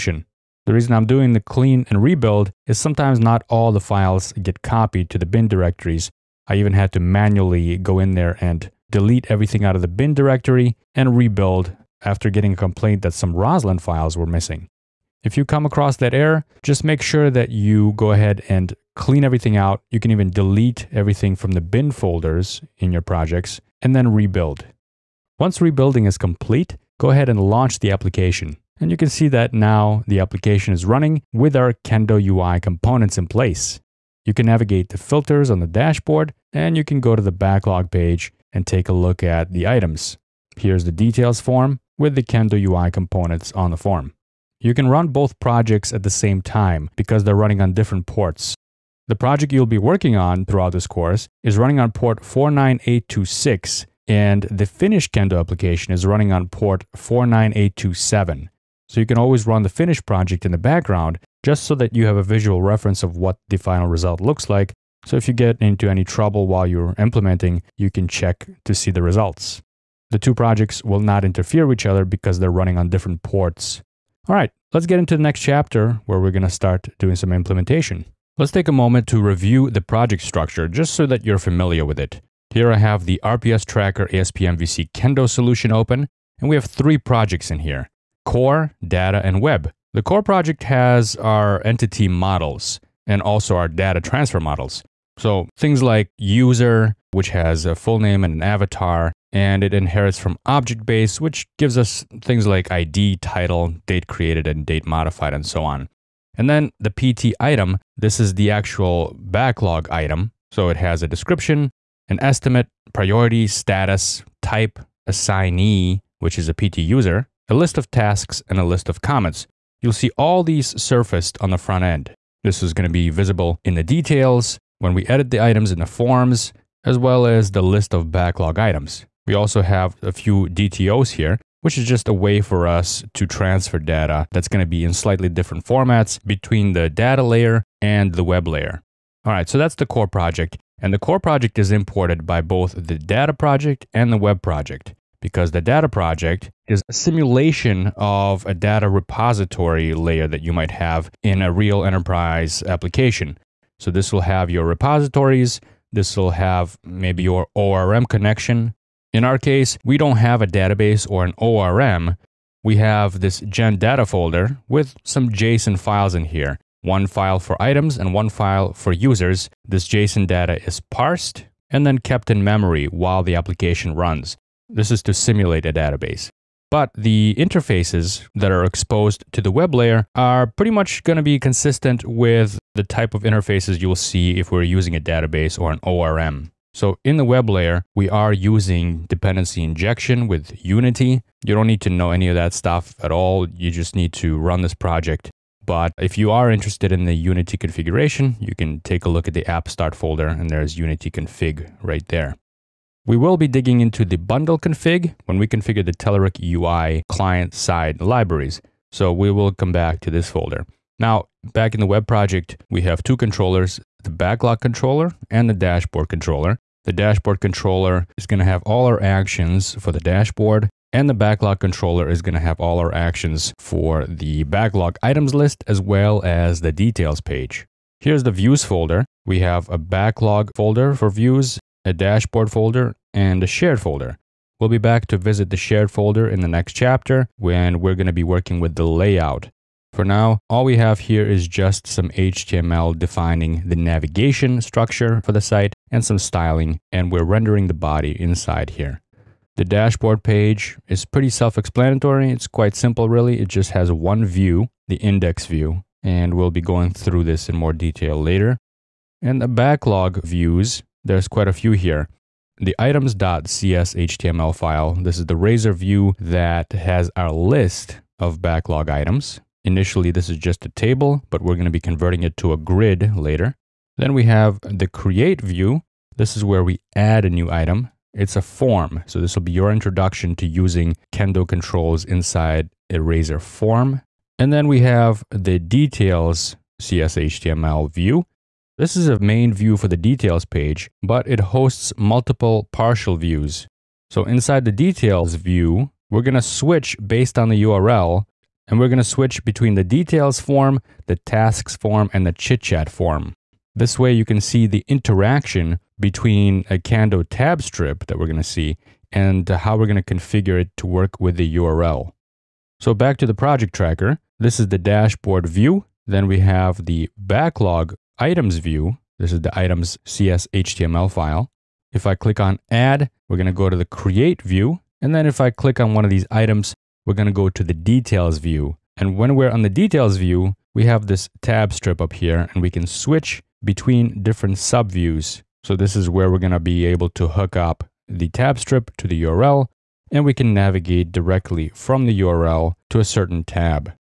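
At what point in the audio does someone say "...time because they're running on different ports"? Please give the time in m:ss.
0:46.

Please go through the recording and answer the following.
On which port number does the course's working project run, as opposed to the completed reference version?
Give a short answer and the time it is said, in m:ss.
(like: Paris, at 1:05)
49826, at 0:52.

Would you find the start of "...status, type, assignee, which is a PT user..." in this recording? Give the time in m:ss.
1:53.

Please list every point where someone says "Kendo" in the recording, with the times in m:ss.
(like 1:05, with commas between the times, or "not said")
0:31, 0:42, 0:55, 1:24, 4:41, 5:06.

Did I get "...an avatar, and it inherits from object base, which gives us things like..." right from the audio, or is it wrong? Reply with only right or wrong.
right.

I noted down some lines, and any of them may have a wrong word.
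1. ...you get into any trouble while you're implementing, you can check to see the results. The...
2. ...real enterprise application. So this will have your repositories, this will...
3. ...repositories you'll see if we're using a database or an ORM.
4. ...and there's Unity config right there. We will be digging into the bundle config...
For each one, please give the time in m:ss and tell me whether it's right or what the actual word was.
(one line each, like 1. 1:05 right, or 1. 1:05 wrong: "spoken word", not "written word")
1. 1:05 right
2. 2:31 right
3. 3:03 wrong: "interfaces", not "repositories"
4. 3:20 right.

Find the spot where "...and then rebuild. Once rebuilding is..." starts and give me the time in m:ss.
0:23.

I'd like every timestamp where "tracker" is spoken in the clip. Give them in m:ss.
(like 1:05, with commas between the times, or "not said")
1:23, 5:13.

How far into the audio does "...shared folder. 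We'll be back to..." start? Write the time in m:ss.
3:53.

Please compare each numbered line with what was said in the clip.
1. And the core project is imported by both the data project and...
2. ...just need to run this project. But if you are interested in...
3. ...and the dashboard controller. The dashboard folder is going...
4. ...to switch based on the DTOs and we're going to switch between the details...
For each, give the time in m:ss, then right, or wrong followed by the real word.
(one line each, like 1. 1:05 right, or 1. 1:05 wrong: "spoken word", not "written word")
1. 2:20 right
2. 3:13 right
3. 3:35 wrong: "controller", not "folder"
4. 4:56 wrong: "URL", not "DTOs".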